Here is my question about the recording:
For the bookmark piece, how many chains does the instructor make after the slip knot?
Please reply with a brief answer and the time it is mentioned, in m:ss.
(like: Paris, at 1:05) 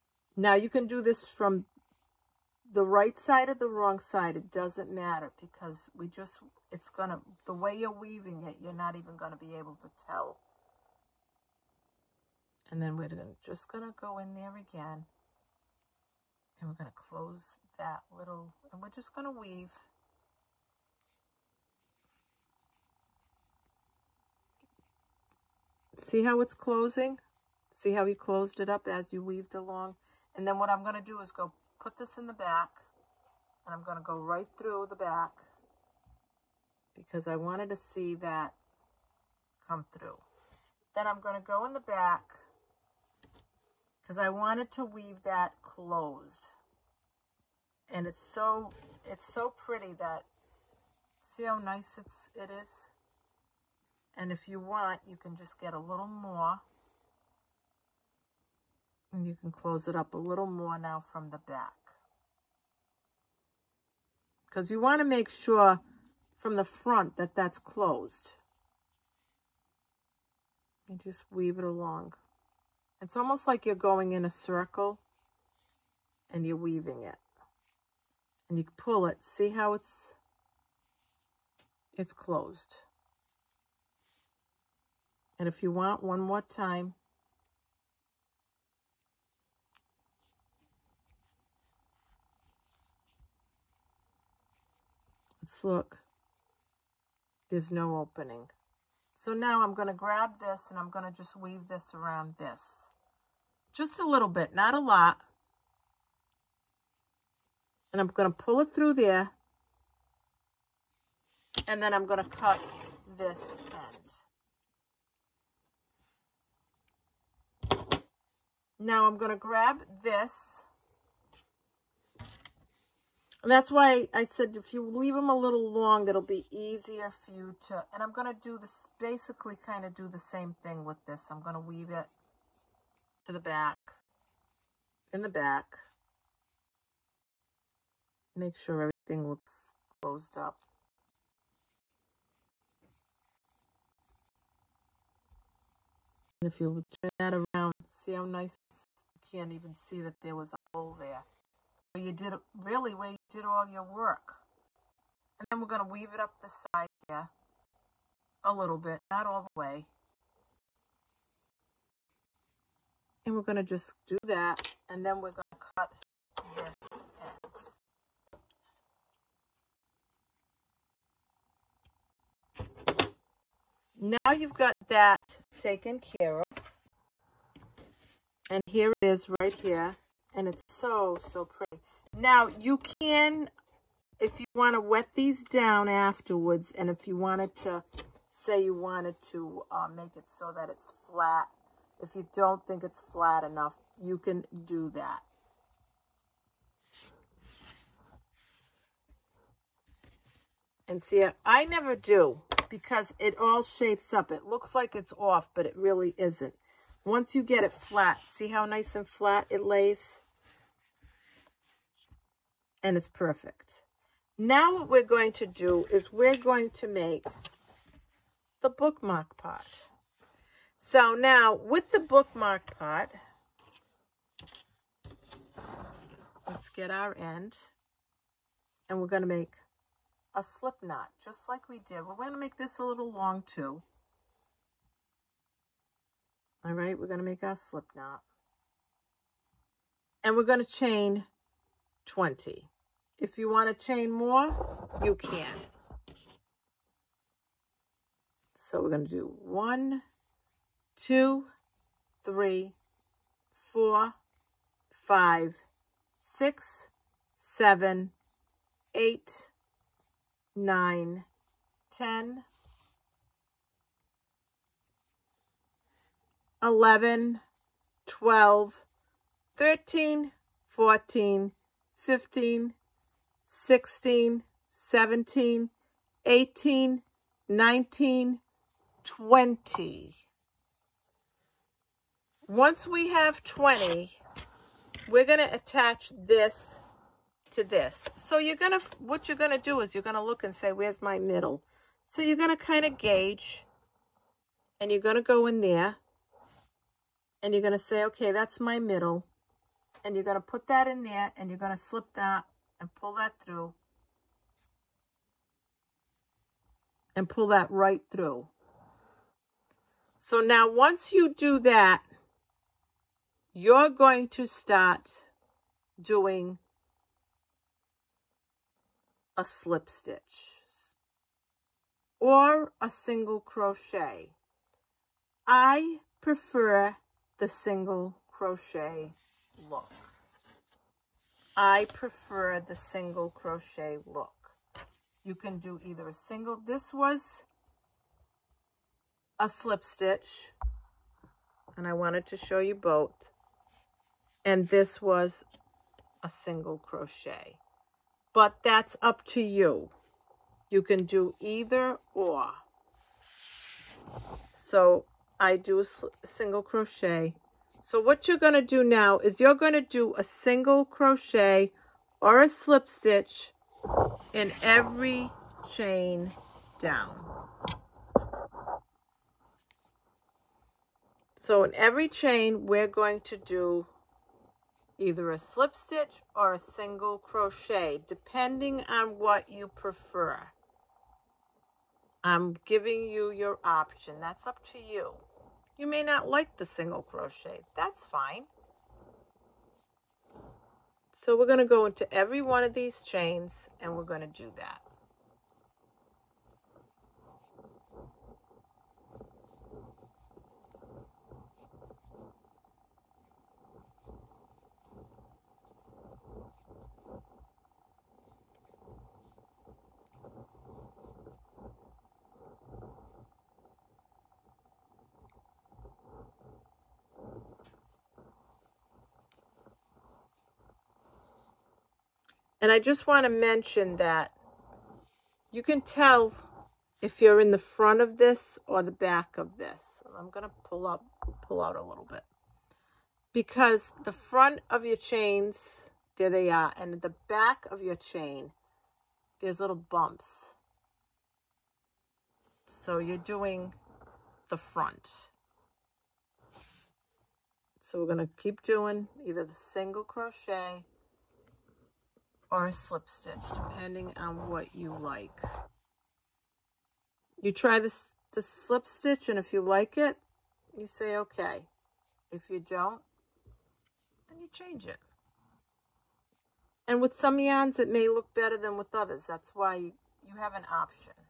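20, at 4:00.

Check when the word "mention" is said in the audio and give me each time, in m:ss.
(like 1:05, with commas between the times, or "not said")
7:03.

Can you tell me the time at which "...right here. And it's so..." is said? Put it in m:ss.
2:59.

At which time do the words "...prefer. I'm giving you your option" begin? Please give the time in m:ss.
6:19.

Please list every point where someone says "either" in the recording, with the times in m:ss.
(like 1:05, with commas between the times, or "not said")
5:35, 5:51, 6:15, 7:29.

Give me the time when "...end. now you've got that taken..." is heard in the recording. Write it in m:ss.
2:52.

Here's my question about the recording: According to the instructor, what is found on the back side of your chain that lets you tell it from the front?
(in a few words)
little bumps.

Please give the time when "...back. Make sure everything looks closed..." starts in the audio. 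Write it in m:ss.
2:15.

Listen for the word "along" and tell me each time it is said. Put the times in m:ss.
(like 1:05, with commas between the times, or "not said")
0:29, 1:11.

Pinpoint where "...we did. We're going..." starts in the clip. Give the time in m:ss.
3:51.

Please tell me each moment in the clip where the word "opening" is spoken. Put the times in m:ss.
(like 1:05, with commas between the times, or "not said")
1:37.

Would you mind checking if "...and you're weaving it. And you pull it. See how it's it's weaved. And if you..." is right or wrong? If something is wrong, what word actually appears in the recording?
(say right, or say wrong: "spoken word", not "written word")
wrong: "closed", not "weaved".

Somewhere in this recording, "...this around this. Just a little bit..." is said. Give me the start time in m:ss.
1:41.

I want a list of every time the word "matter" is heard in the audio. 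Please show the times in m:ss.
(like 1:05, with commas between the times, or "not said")
0:04.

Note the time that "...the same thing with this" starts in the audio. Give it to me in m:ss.
2:10.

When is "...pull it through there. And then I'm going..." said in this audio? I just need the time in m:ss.
1:48.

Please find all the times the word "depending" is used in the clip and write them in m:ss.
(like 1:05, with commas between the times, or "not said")
6:18, 7:33.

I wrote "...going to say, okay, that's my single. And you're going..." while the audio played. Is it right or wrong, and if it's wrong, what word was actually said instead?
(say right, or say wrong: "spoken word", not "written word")
wrong: "middle", not "single".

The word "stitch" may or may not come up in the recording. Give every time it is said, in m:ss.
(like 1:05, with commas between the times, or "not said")
5:19, 5:39, 6:02, 6:15, 7:33, 7:38.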